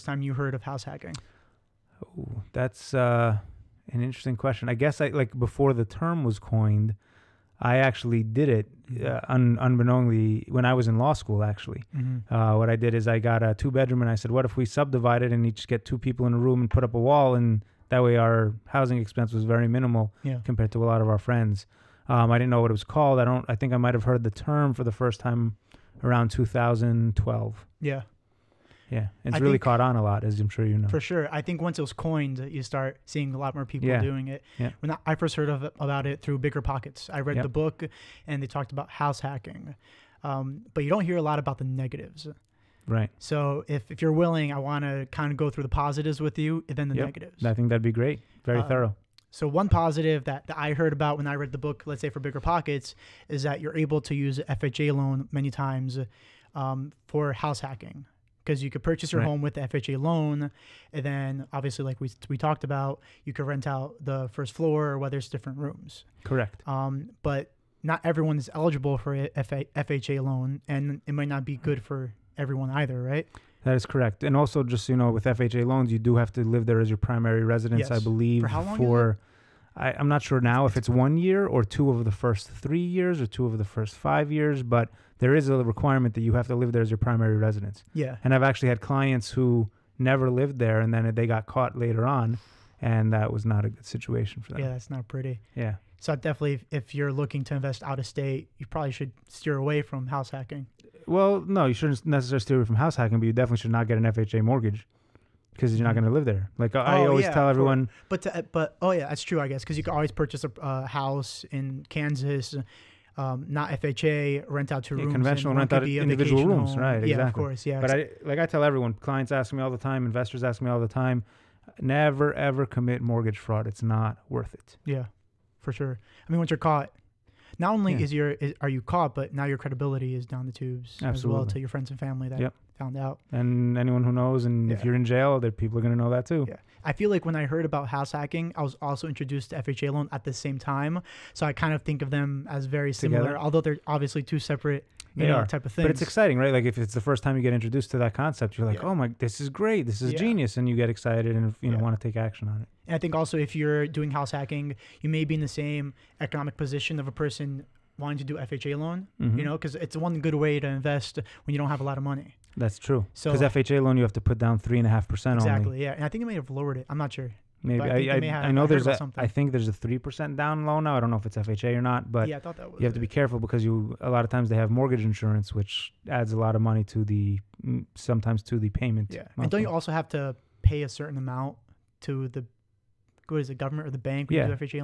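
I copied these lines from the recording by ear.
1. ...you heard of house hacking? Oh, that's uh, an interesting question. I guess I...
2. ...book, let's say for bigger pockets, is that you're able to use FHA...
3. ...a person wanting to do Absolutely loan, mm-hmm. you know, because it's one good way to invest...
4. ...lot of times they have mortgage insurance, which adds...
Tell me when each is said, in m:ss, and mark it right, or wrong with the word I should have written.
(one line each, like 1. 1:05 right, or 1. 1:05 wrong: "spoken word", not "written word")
1. 0:00 right
2. 0:51 right
3. 2:37 wrong: "FHA", not "Absolutely"
4. 2:54 right.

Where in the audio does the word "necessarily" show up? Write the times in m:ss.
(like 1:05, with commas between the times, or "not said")
1:42.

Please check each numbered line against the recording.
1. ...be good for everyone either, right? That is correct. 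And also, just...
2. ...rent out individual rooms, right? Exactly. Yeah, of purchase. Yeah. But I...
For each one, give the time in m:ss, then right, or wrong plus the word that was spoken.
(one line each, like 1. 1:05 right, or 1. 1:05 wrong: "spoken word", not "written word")
1. 1:11 right
2. 1:55 wrong: "course", not "purchase".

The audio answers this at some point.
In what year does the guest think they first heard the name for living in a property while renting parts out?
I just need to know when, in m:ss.
0:26.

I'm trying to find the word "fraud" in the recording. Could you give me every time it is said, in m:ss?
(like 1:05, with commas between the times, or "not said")
2:03.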